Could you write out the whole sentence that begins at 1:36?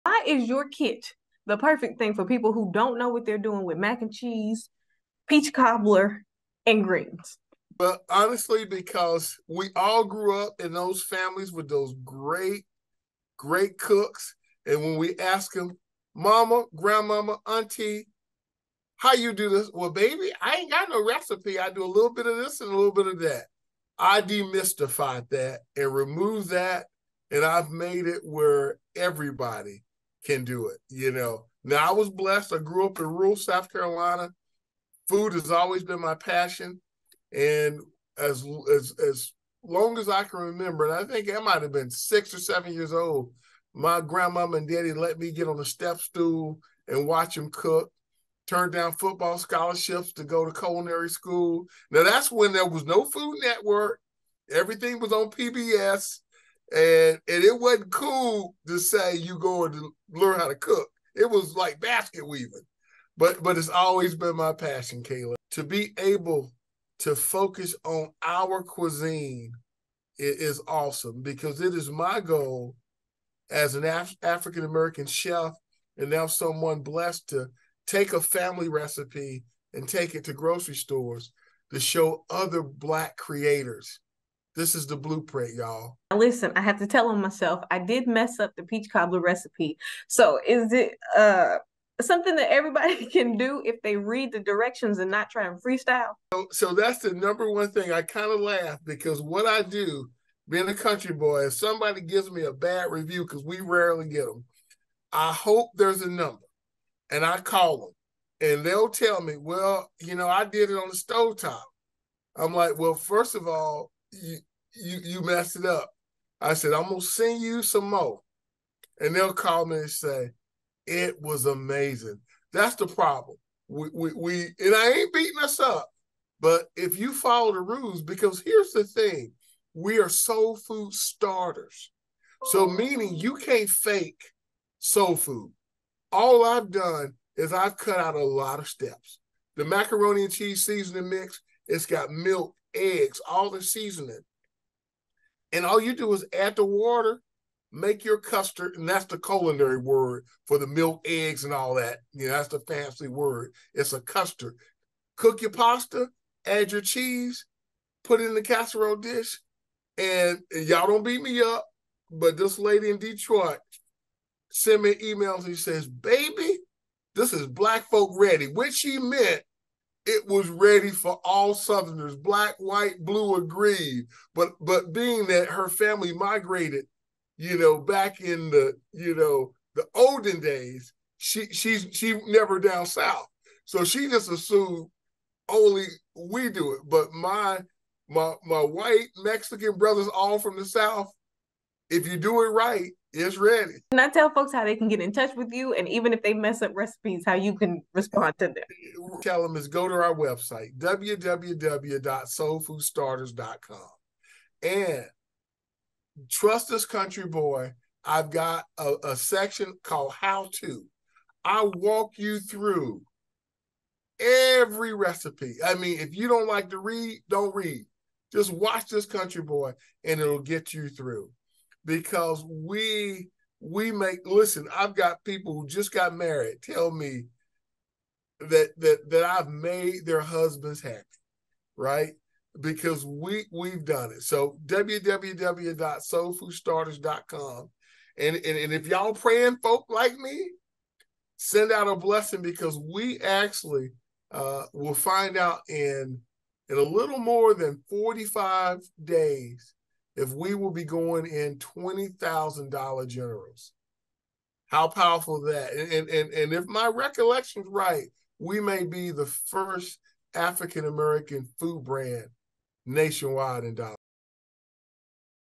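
So, so that's the number one thing.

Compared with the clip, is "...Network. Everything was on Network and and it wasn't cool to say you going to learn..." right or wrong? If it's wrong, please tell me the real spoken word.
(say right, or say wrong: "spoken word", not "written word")
wrong: "PBS", not "Network".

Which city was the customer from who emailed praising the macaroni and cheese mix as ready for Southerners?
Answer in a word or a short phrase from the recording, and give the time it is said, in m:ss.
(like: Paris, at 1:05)
Detroit, at 2:42.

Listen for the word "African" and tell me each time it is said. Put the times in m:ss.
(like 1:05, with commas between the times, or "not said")
1:14, 4:20.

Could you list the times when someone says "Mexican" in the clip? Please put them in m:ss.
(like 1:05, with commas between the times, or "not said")
3:09.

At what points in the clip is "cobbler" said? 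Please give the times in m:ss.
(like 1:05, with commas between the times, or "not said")
0:05, 1:28.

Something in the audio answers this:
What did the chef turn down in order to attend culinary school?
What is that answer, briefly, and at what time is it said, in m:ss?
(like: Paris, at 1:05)
football scholarships, at 0:48.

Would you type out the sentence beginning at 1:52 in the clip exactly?
I'm like, well, first of all, you you you messed it up.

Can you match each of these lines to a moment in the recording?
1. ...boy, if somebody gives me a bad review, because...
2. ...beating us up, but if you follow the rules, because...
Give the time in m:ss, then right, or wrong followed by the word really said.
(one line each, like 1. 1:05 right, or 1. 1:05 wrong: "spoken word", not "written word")
1. 1:41 right
2. 2:05 right.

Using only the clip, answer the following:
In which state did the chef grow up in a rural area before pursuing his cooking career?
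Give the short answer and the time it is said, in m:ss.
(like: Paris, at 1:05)
South Carolina, at 0:33.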